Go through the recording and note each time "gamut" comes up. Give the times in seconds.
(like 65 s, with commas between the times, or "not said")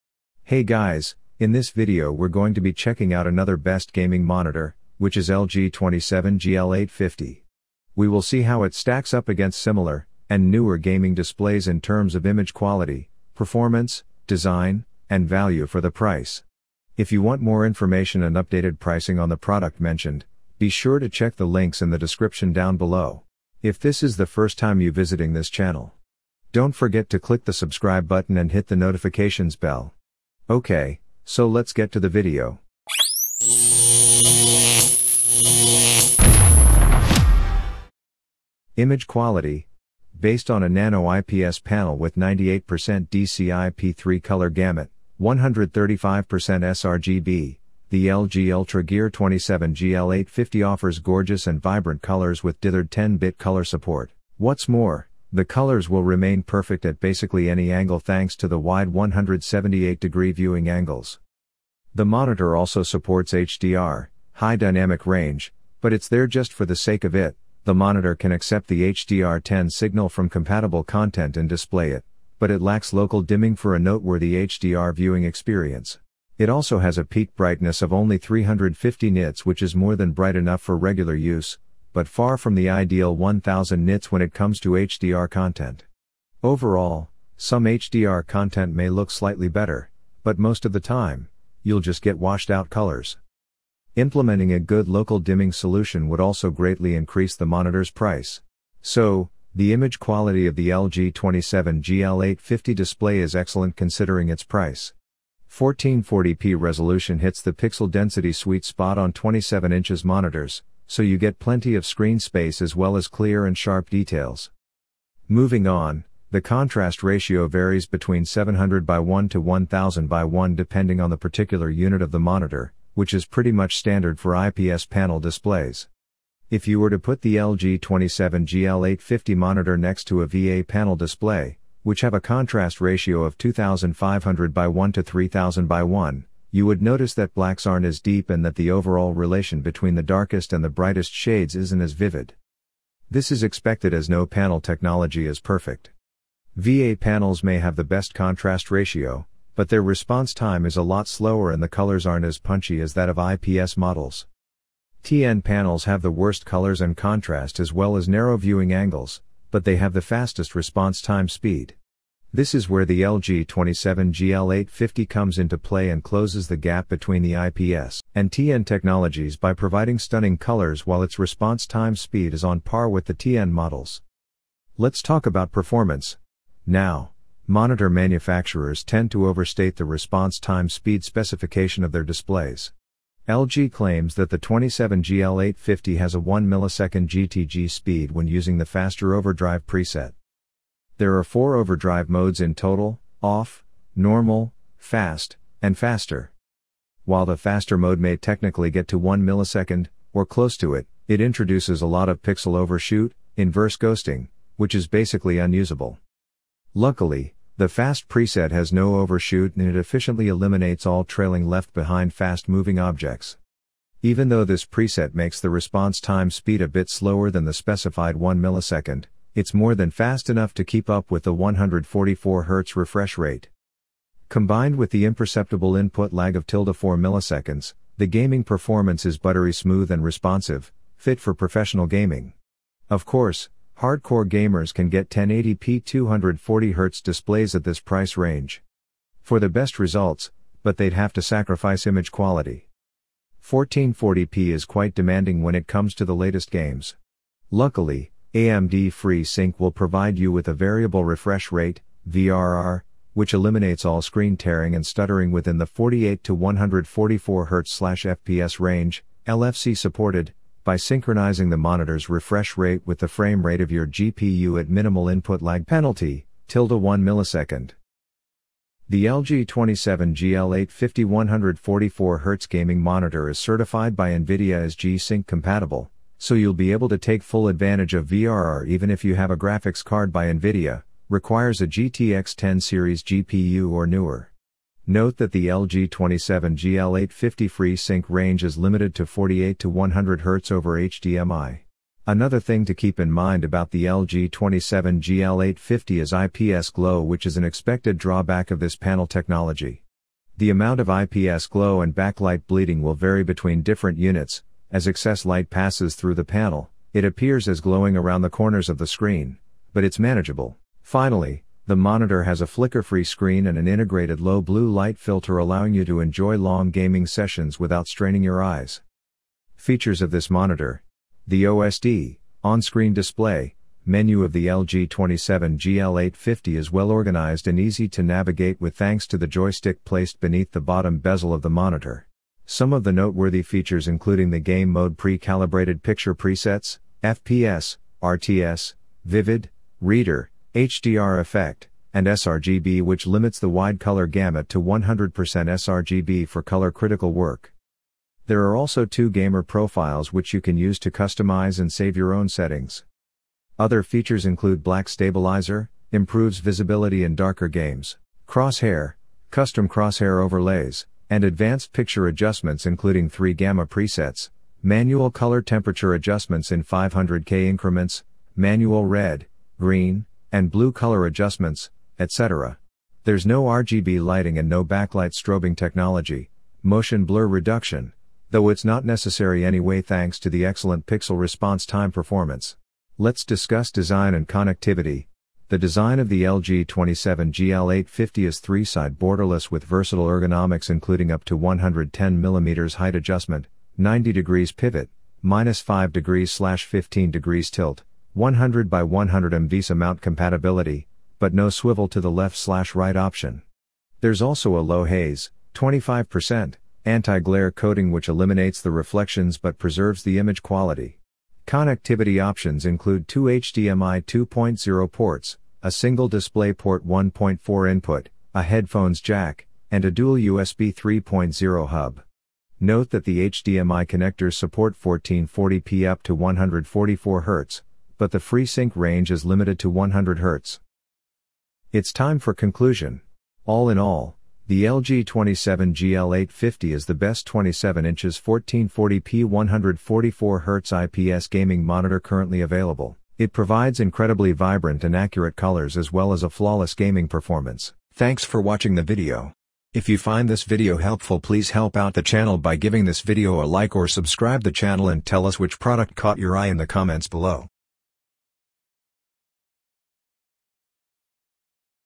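44 s, 344 s.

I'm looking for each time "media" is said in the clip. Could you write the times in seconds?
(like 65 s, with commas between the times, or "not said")
not said.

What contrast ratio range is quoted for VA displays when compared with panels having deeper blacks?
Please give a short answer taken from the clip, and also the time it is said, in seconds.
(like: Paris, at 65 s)
2500:1 to 3000:1, at 133 s.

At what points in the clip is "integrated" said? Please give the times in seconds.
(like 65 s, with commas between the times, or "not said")
313 s.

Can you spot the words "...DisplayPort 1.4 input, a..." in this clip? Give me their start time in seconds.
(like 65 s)
416 s.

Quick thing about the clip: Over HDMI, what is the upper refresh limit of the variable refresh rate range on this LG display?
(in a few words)
100 Hz.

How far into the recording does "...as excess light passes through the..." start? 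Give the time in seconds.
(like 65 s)
304 s.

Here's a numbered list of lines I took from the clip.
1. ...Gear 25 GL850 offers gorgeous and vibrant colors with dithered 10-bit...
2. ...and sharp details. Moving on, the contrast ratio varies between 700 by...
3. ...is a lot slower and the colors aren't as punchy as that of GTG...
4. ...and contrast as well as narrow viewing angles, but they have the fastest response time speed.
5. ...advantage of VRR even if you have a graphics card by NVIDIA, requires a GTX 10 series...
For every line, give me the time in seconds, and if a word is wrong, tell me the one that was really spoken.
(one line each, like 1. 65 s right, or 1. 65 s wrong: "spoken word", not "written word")
1. 48 s wrong: "27", not "25"
2. 113 s right
3. 150 s wrong: "IPS", not "GTG"
4. 156 s right
5. 277 s right.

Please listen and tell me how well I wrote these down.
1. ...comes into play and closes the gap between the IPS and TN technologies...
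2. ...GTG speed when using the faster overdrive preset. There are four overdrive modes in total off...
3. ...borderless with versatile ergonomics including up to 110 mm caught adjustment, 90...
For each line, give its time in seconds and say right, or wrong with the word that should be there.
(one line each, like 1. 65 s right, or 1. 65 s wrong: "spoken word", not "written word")
1. 165 s right
2. 187 s right
3. 388 s wrong: "height", not "caught".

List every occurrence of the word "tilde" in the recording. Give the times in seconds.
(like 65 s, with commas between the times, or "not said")
226 s, 266 s.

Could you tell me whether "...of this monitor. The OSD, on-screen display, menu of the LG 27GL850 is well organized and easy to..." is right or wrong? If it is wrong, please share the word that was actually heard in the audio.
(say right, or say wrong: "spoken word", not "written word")
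right.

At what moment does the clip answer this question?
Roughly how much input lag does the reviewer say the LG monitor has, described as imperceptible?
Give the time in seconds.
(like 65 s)
226 s.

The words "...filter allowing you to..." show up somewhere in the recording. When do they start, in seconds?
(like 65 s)
314 s.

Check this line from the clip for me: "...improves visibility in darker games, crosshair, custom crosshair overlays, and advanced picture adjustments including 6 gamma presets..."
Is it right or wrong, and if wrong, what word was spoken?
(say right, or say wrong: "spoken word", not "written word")
wrong: "3", not "6".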